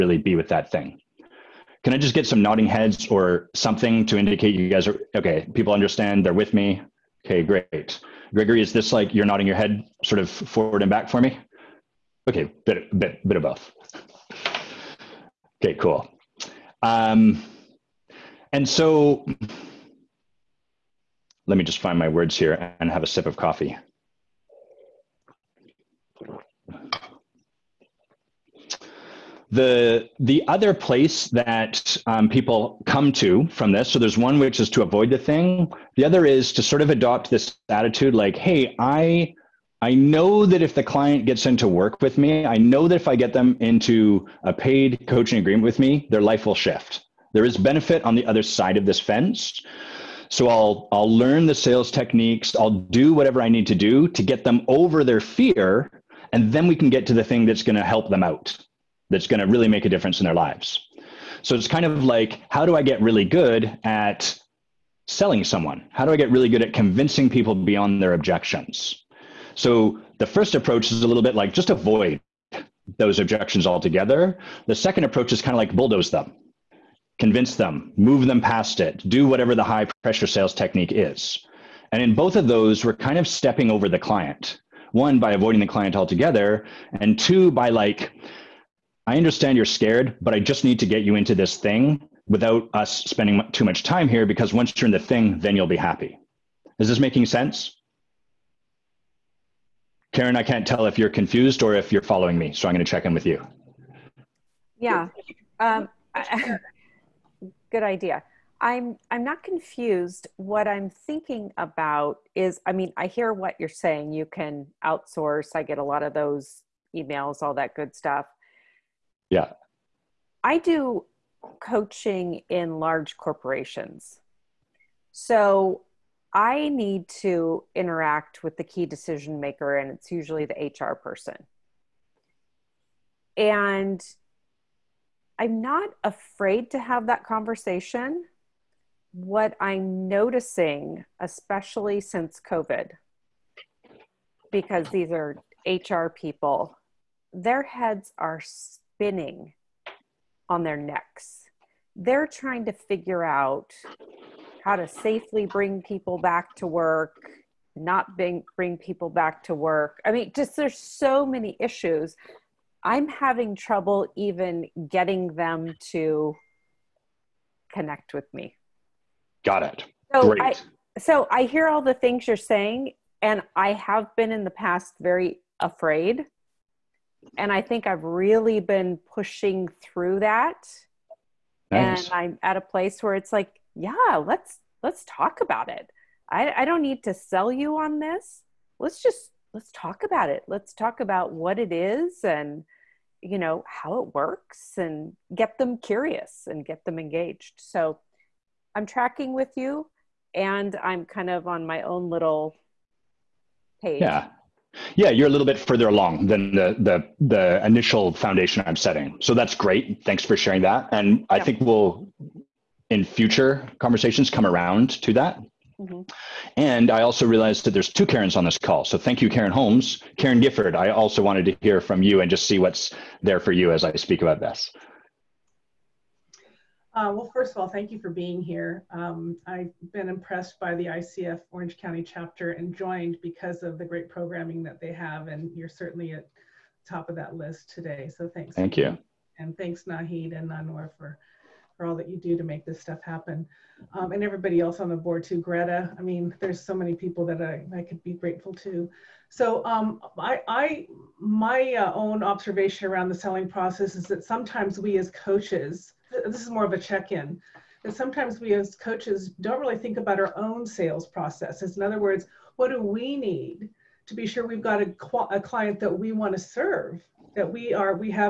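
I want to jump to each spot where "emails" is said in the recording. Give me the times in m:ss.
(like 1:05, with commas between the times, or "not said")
1:56.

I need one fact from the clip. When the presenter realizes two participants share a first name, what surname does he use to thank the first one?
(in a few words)
Holmes.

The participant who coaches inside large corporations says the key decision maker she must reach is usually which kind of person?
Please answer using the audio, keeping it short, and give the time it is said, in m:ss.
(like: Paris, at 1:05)
the HR person, at 2:10.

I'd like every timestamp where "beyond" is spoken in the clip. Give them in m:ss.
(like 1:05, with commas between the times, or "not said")
1:07.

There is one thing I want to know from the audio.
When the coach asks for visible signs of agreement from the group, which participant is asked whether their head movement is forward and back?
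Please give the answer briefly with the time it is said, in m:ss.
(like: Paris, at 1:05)
Gregory, at 0:08.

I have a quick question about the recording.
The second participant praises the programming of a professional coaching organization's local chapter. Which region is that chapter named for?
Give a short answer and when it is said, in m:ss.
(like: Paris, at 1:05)
Orange County, at 3:51.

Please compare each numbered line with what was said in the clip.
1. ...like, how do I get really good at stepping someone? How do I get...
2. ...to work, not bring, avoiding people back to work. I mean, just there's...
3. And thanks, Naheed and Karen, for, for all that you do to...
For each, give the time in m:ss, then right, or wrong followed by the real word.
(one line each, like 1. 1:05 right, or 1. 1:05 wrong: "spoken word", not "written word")
1. 1:02 wrong: "selling", not "stepping"
2. 2:36 wrong: "bring", not "avoiding"
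3. 3:59 wrong: "Nanor", not "Karen".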